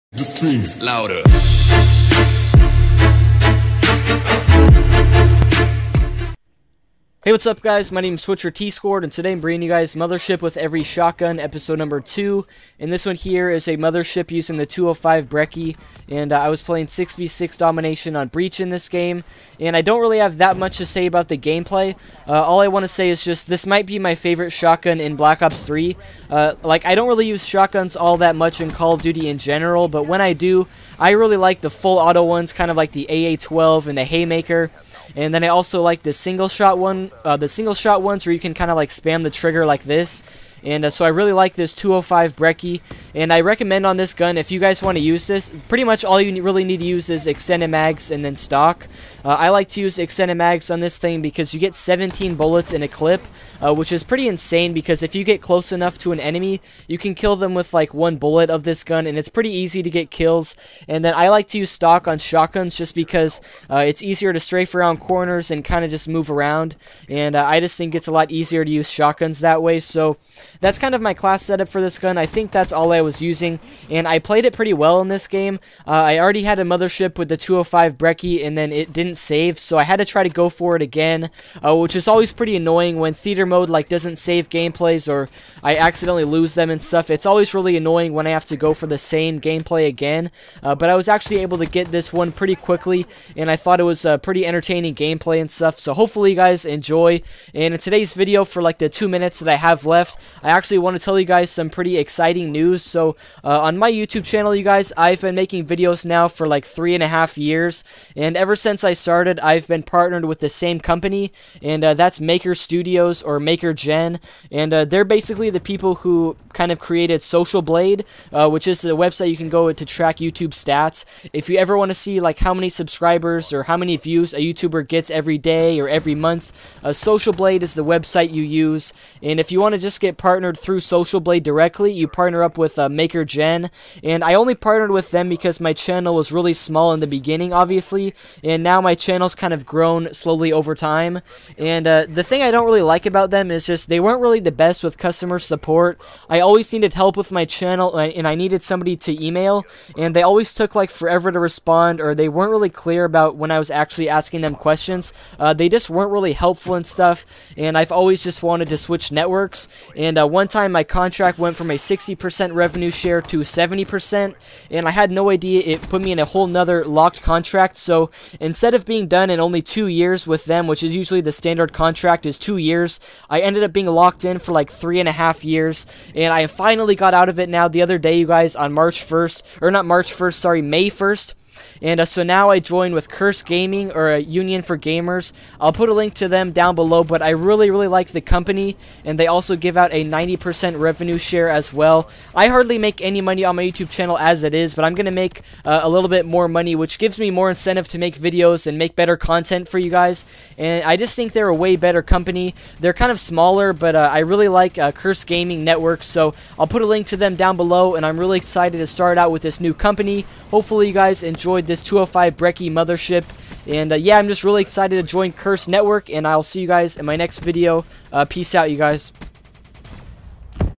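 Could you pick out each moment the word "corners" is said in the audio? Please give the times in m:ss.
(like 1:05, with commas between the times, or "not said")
1:04.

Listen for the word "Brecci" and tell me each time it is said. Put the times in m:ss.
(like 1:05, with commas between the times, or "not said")
0:15, 0:42, 1:17, 3:32.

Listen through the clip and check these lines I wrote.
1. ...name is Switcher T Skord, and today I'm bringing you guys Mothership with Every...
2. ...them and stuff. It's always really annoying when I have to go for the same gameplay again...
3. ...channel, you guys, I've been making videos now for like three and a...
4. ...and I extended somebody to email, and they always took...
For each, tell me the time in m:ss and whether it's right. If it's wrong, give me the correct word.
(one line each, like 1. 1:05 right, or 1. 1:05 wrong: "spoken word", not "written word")
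1. 0:08 right
2. 1:26 right
3. 1:44 right
4. 2:27 wrong: "needed", not "extended".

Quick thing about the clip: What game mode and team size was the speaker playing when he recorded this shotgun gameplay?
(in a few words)
6v6 domination.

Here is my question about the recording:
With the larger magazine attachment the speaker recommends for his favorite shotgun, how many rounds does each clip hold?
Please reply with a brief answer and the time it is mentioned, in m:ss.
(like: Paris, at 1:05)
17, at 0:51.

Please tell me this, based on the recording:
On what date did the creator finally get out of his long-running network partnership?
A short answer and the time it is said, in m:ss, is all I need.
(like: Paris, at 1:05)
May 1st, at 3:00.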